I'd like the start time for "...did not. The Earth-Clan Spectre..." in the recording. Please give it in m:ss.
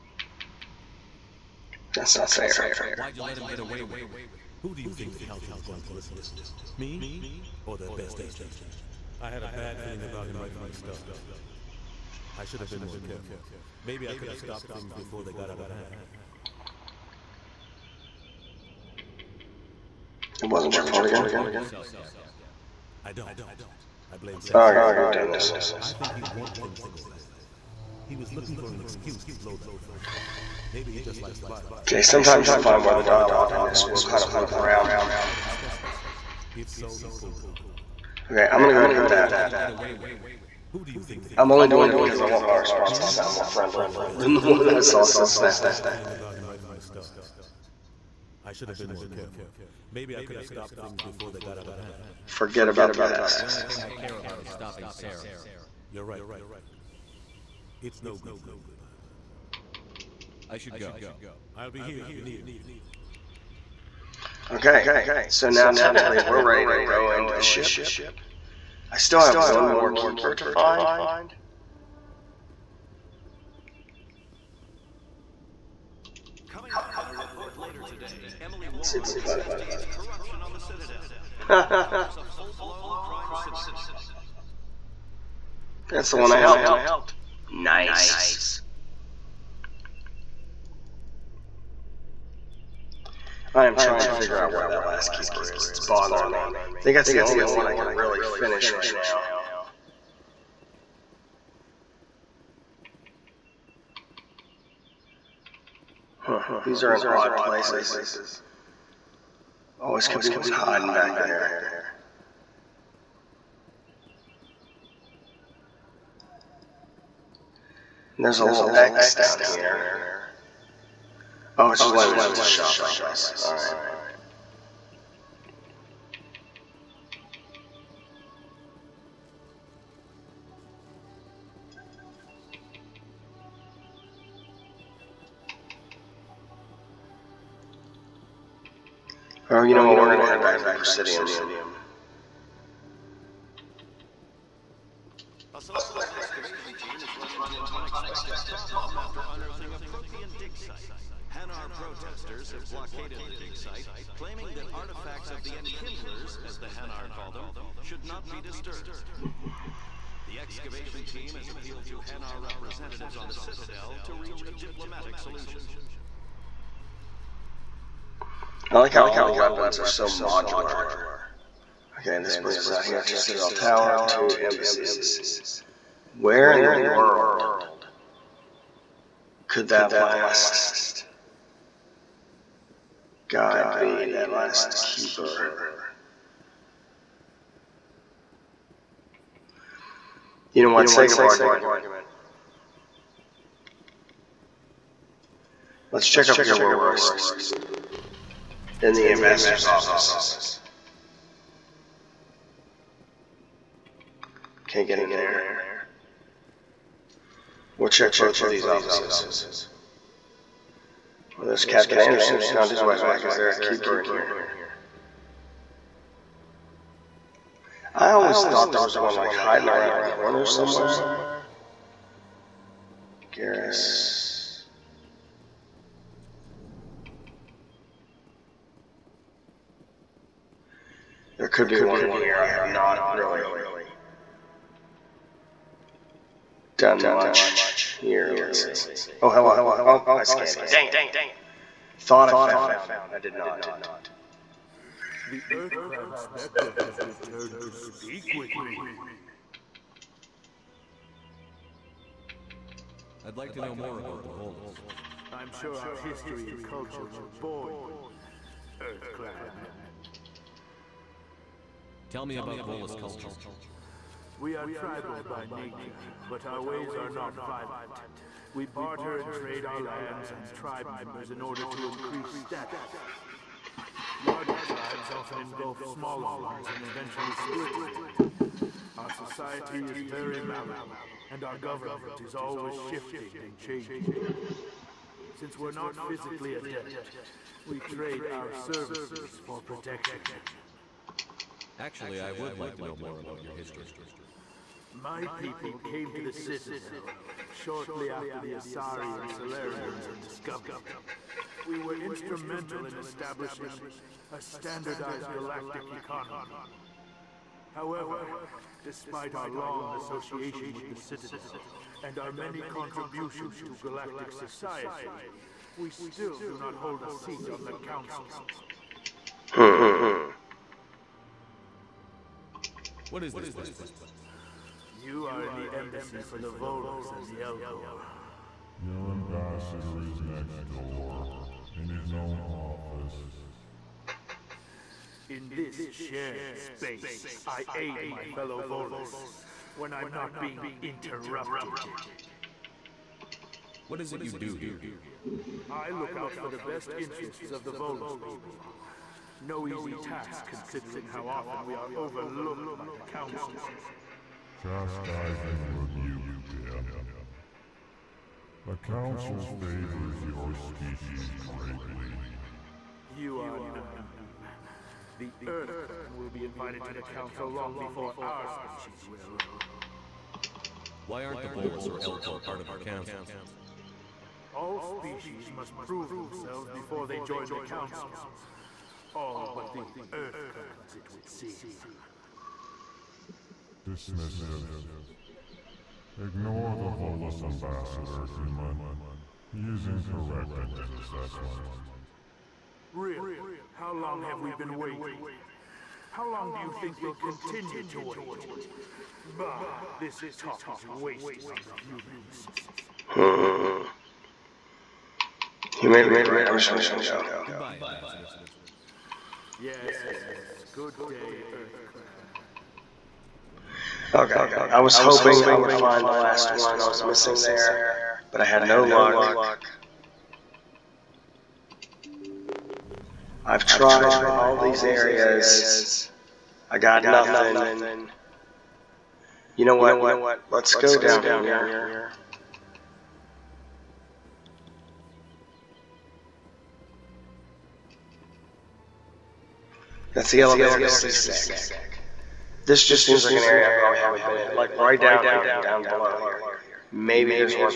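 4:03.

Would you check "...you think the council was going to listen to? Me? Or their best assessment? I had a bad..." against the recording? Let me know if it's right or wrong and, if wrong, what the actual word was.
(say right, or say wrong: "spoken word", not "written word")
wrong: "agent", not "assessment".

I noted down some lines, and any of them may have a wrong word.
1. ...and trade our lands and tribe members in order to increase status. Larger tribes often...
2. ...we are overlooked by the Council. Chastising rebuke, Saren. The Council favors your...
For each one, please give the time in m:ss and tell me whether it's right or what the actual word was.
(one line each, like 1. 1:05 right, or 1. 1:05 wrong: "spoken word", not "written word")
1. 4:29 right
2. 5:51 wrong: "Din", not "Saren".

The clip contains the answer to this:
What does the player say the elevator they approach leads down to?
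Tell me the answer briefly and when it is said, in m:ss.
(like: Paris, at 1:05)
CSEC, at 7:20.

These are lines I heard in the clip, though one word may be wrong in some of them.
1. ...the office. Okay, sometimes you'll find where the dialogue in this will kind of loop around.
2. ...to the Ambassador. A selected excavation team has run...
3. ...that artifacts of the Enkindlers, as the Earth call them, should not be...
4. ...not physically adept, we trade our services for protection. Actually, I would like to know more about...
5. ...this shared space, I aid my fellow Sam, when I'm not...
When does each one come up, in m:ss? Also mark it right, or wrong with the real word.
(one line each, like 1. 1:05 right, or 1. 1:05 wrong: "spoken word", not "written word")
1. 0:31 wrong: "violence", not "office"
2. 2:20 wrong: "Presidium", not "Ambassador"
3. 2:34 wrong: "Hanar", not "Earth"
4. 4:45 right
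5. 5:35 wrong: "Volus", not "Sam".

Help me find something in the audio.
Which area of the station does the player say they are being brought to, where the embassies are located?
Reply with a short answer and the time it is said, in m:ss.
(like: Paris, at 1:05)
Citadel Tower, at 2:53.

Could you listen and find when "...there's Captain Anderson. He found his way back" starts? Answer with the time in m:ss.
3:31.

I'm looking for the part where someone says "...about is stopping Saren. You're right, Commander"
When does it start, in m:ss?
0:54.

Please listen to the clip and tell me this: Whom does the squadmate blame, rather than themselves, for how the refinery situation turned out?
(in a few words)
Sam.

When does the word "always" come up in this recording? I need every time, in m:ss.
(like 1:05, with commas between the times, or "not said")
1:49, 3:38, 4:42.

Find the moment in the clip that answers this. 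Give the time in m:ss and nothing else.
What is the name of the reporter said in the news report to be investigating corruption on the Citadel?
1:18.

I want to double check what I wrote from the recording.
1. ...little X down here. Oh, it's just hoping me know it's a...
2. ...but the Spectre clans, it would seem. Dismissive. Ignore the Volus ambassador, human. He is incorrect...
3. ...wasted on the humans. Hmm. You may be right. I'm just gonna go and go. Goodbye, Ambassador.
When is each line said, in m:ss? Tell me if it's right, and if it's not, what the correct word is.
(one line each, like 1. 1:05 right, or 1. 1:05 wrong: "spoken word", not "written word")
1. 1:58 wrong: "letting", not "hoping"
2. 6:19 wrong: "Earth", not "Spectre"
3. 6:40 right.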